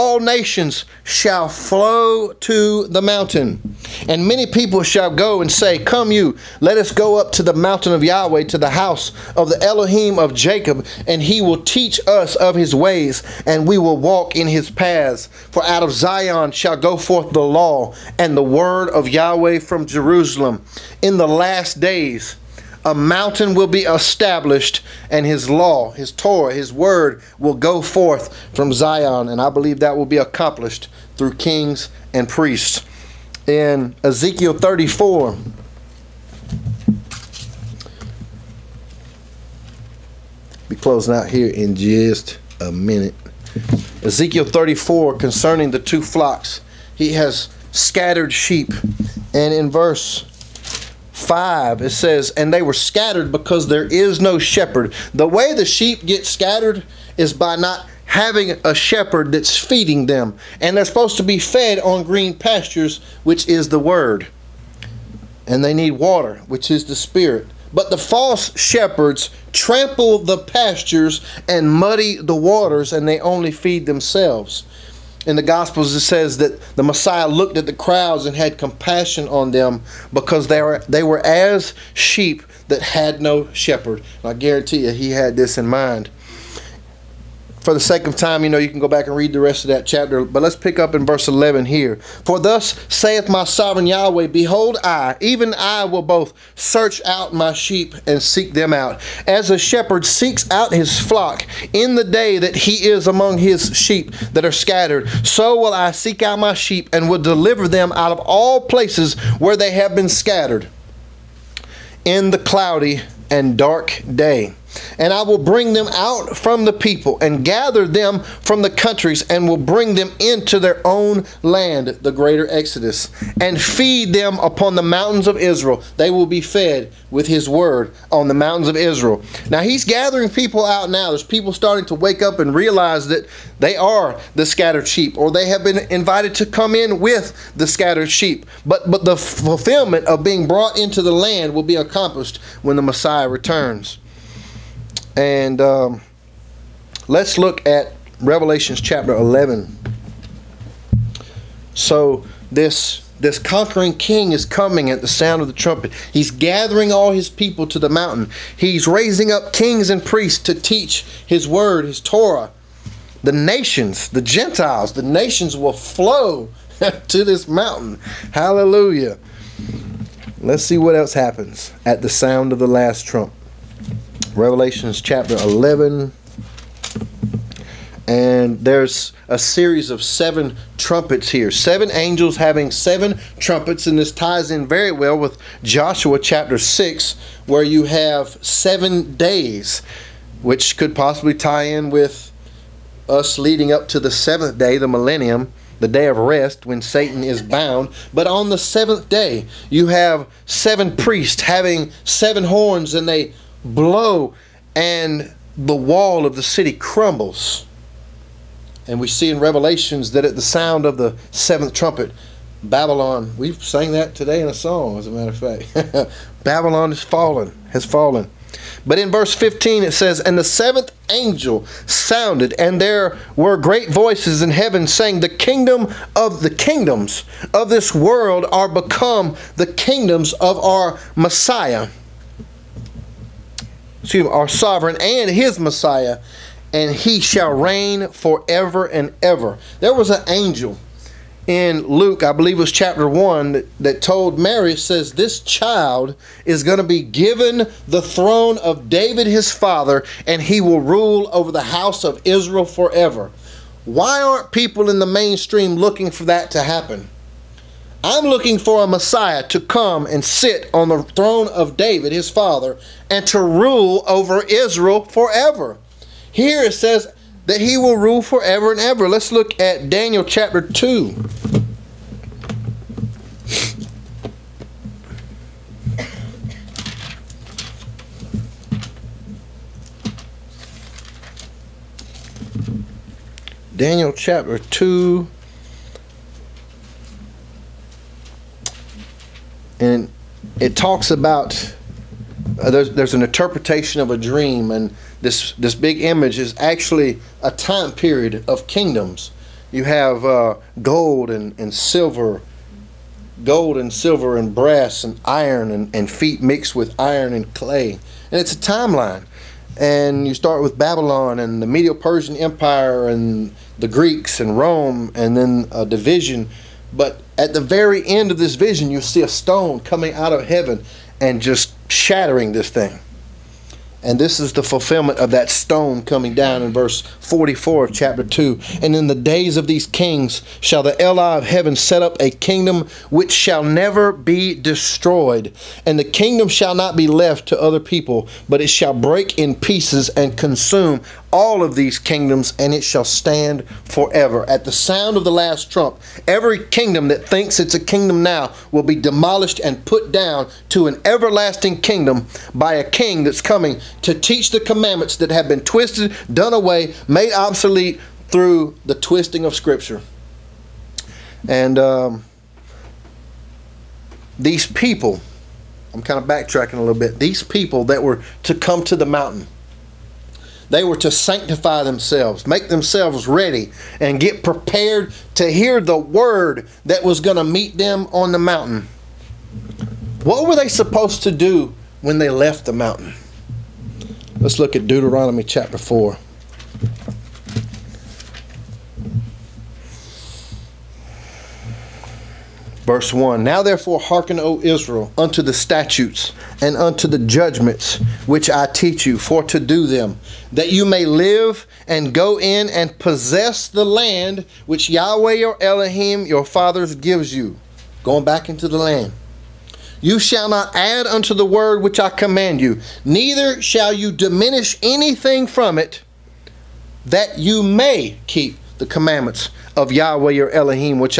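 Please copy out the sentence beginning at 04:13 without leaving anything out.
Why aren't people in the mainstream looking for that to happen?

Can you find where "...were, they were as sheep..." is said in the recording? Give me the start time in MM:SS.
01:20.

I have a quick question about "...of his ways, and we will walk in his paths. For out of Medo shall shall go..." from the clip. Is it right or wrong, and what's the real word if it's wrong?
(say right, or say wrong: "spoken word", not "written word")
wrong: "Zion", not "Medo".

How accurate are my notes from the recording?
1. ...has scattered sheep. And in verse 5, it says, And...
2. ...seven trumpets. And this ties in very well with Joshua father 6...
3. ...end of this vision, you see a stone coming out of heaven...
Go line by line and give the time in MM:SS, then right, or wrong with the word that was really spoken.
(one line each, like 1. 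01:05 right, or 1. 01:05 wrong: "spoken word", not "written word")
1. 00:47 right
2. 03:02 wrong: "chapter", not "father"
3. 05:18 right.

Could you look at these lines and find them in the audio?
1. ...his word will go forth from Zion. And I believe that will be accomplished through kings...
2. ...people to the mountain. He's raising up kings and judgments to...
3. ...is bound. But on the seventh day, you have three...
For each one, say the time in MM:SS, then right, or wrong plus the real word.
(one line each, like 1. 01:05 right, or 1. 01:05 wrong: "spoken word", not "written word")
1. 00:26 right
2. 02:37 wrong: "priests", not "judgments"
3. 03:17 wrong: "seven", not "three".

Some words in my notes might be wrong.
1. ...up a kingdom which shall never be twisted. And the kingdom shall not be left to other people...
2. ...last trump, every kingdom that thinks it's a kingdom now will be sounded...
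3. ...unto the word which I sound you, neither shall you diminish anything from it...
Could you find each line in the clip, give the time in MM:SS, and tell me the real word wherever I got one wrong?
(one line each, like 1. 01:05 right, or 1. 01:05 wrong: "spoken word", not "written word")
1. 05:32 wrong: "destroyed", not "twisted"
2. 05:45 wrong: "demolished", not "sounded"
3. 06:51 wrong: "command", not "sound".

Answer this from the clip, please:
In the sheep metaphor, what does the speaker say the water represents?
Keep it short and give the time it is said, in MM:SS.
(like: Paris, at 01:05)
The spirit, at 01:06.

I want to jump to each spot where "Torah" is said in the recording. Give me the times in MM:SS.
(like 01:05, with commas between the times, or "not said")
00:26, 02:41.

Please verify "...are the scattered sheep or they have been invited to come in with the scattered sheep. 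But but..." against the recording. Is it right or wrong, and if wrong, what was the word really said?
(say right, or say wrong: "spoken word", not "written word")
right.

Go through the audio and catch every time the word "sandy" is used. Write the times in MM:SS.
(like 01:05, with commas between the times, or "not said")
not said.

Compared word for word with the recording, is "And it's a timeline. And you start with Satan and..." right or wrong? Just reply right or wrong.
wrong.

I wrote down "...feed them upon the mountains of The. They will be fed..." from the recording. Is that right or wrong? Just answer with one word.
wrong.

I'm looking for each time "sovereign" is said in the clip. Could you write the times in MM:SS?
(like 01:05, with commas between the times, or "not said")
01:33, 03:54.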